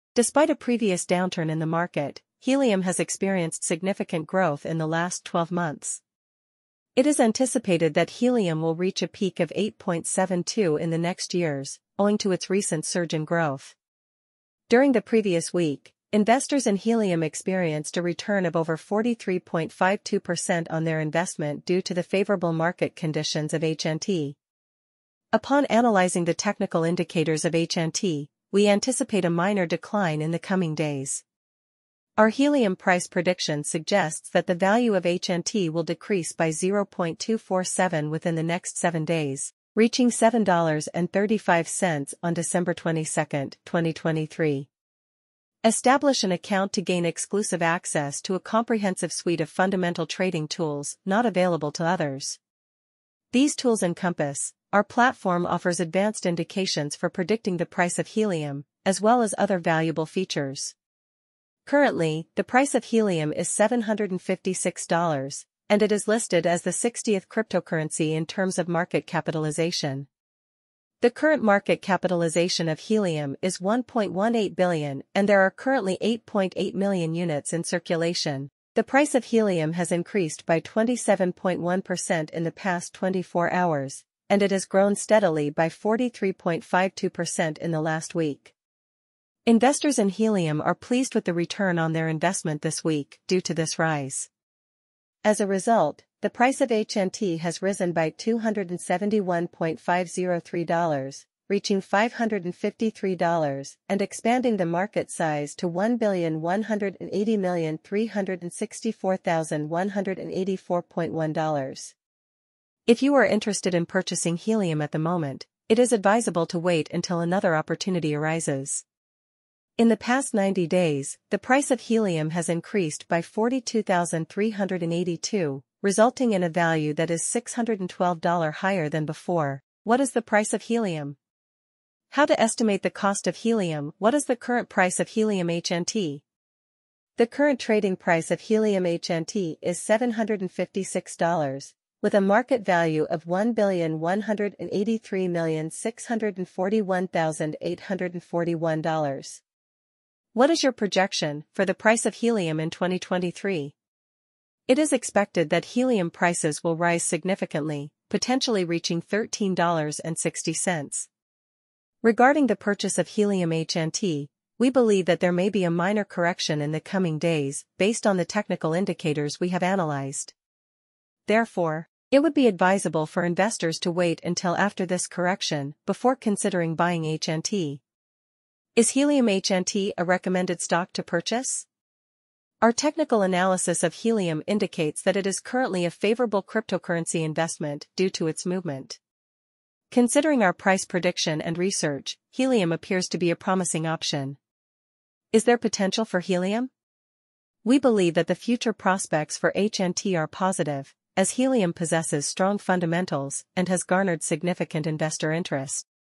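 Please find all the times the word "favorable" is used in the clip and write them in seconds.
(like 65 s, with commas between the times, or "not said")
22 s, 185 s.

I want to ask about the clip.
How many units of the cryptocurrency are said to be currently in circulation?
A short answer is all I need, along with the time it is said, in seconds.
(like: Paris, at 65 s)
8.8 million, at 76 s.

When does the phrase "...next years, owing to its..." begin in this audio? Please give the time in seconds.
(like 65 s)
10 s.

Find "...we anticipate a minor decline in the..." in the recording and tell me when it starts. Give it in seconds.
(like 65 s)
28 s.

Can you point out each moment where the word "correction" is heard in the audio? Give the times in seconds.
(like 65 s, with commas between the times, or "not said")
166 s, 175 s.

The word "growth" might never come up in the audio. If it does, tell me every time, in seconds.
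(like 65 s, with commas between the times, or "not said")
4 s, 13 s.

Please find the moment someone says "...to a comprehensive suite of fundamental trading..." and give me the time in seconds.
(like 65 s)
48 s.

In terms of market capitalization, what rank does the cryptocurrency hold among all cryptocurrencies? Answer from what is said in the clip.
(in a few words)
60th.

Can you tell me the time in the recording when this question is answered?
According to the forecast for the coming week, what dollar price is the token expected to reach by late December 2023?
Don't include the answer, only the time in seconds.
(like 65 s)
40 s.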